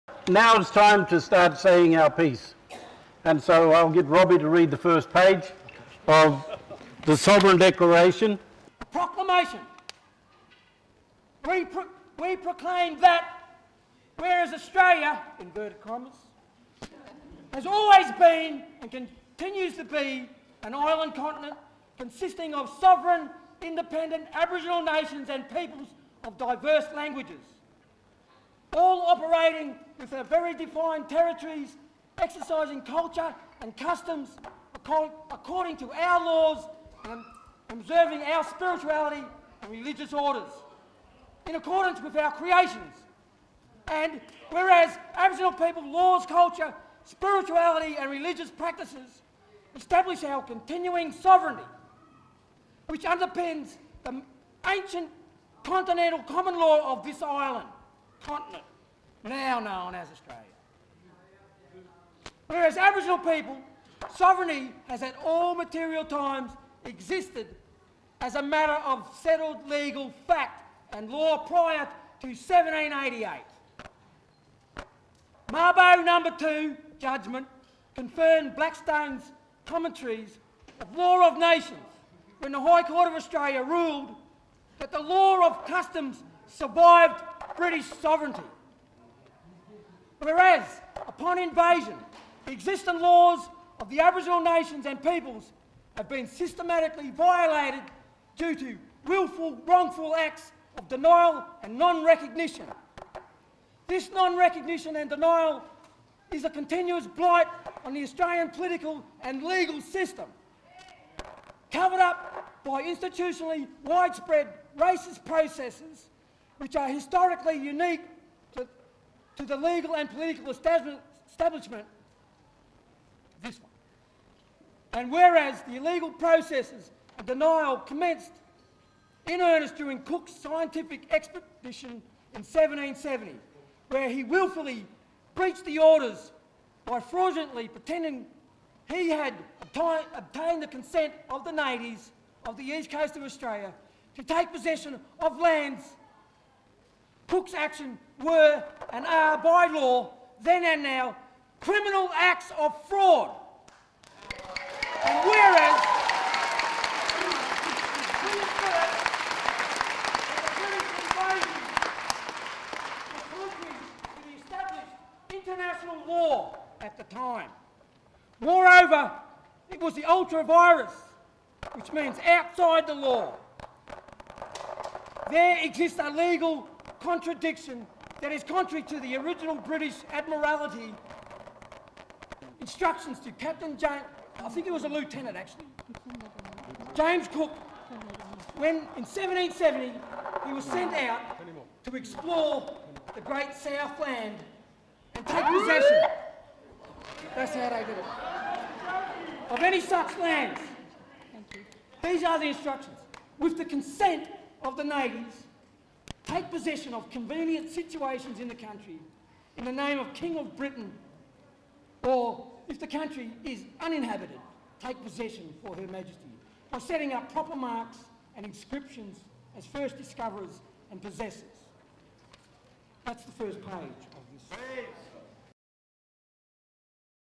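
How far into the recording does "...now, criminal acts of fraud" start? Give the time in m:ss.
2:30.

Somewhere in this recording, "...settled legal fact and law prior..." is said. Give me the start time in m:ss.
1:09.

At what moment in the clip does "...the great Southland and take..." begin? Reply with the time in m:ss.
3:13.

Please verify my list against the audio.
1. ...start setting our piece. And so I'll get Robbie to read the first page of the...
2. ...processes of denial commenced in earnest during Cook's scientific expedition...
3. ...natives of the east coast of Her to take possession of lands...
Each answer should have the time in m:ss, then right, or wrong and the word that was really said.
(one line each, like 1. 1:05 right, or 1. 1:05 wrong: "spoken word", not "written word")
1. 0:01 wrong: "saying", not "setting"
2. 2:06 right
3. 2:21 wrong: "Australia", not "Her".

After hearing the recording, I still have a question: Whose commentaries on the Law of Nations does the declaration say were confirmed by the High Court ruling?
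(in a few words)
Blackstone's.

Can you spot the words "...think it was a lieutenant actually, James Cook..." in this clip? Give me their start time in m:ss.
3:04.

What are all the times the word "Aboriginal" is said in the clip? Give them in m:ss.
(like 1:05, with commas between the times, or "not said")
0:24, 0:45, 1:02, 1:33.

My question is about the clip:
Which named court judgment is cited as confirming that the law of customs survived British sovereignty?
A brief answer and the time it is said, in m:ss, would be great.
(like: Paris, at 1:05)
Mabo number two, at 1:15.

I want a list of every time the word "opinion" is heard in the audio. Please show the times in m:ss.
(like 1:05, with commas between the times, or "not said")
not said.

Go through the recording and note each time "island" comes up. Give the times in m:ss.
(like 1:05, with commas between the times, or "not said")
0:20, 0:57.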